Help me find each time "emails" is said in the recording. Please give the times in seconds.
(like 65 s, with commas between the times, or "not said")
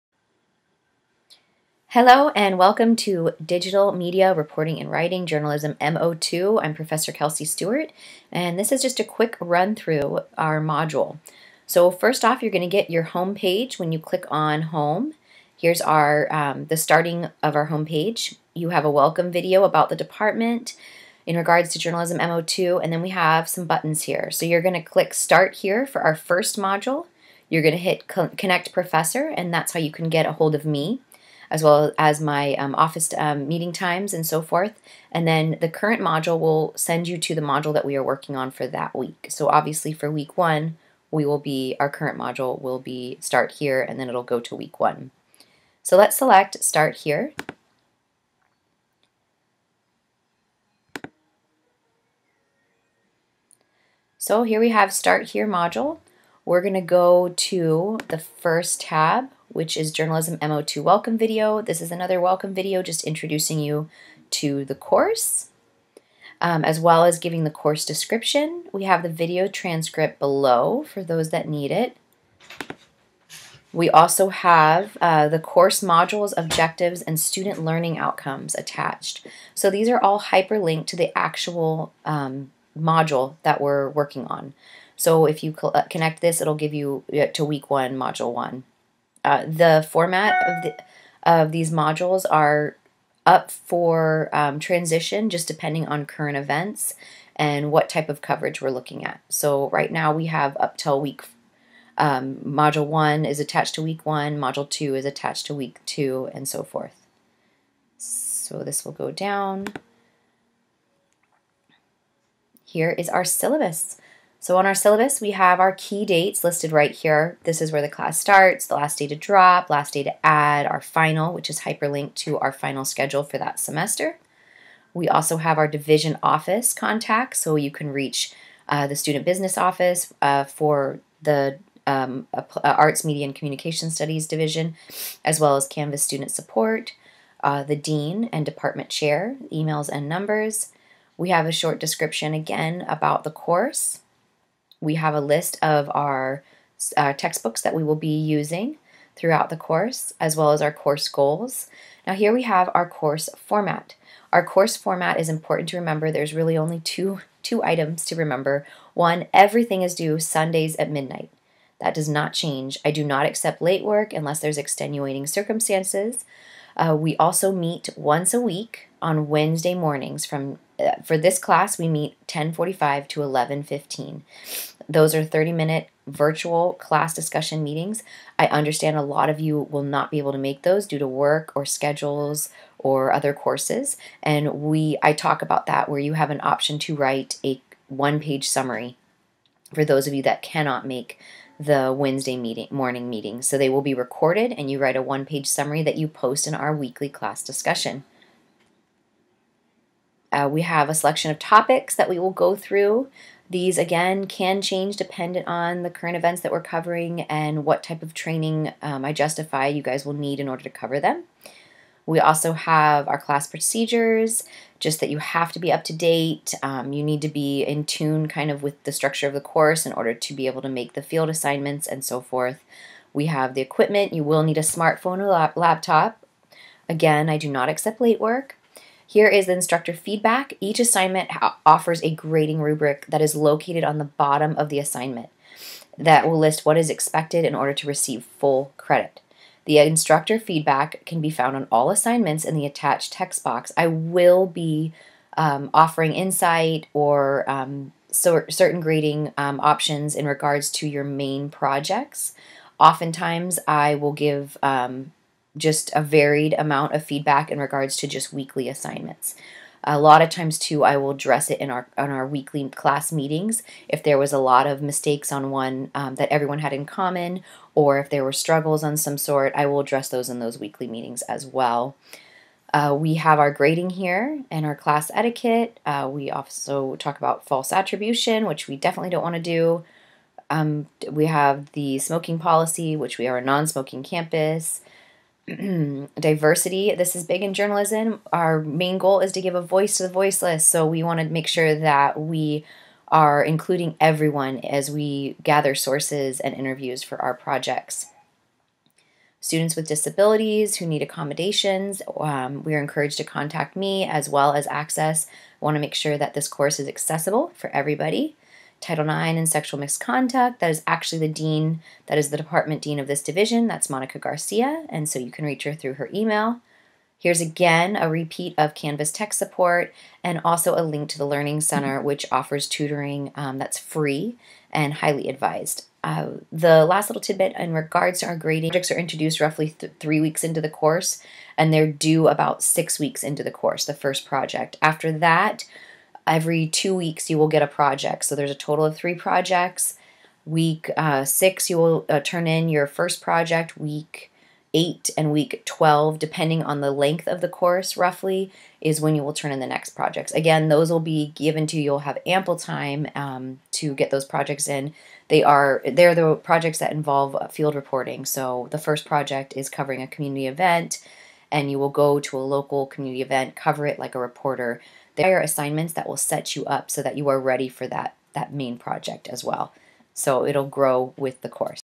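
139 s, 316 s.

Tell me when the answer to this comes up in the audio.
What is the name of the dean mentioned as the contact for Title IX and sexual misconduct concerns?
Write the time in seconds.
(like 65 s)
313 s.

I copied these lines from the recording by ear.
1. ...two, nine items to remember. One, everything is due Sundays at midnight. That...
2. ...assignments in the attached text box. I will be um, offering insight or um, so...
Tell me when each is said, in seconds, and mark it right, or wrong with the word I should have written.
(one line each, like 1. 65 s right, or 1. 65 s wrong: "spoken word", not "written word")
1. 156 s wrong: "two", not "nine"
2. 241 s right.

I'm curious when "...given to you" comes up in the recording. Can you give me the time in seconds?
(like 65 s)
351 s.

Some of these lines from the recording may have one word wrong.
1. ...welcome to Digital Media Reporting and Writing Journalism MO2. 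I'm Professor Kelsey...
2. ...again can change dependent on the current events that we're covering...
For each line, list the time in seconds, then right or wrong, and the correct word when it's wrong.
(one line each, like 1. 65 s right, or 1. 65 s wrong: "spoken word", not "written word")
1. 2 s right
2. 203 s right.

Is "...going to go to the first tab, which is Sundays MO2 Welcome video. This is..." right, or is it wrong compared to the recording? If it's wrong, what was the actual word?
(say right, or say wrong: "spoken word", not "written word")
wrong: "Journalism", not "Sundays".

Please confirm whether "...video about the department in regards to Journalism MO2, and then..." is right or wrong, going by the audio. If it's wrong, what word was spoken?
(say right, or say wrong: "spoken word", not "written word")
right.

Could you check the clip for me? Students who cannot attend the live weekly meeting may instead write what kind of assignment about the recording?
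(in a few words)
one-page summary.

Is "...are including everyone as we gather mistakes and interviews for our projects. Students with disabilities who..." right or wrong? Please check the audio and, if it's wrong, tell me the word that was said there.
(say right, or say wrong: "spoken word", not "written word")
wrong: "sources", not "mistakes".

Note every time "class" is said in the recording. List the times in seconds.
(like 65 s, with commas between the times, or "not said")
117 s, 171 s, 176 s, 197 s, 213 s, 262 s, 274 s.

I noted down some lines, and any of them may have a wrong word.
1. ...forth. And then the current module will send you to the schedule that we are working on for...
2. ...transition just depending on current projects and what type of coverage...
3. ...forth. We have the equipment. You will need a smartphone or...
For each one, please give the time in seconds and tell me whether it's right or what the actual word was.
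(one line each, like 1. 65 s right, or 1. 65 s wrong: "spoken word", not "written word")
1. 34 s wrong: "module", not "schedule"
2. 94 s wrong: "events", not "projects"
3. 222 s right.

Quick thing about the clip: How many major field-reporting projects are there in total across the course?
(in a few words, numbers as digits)
3.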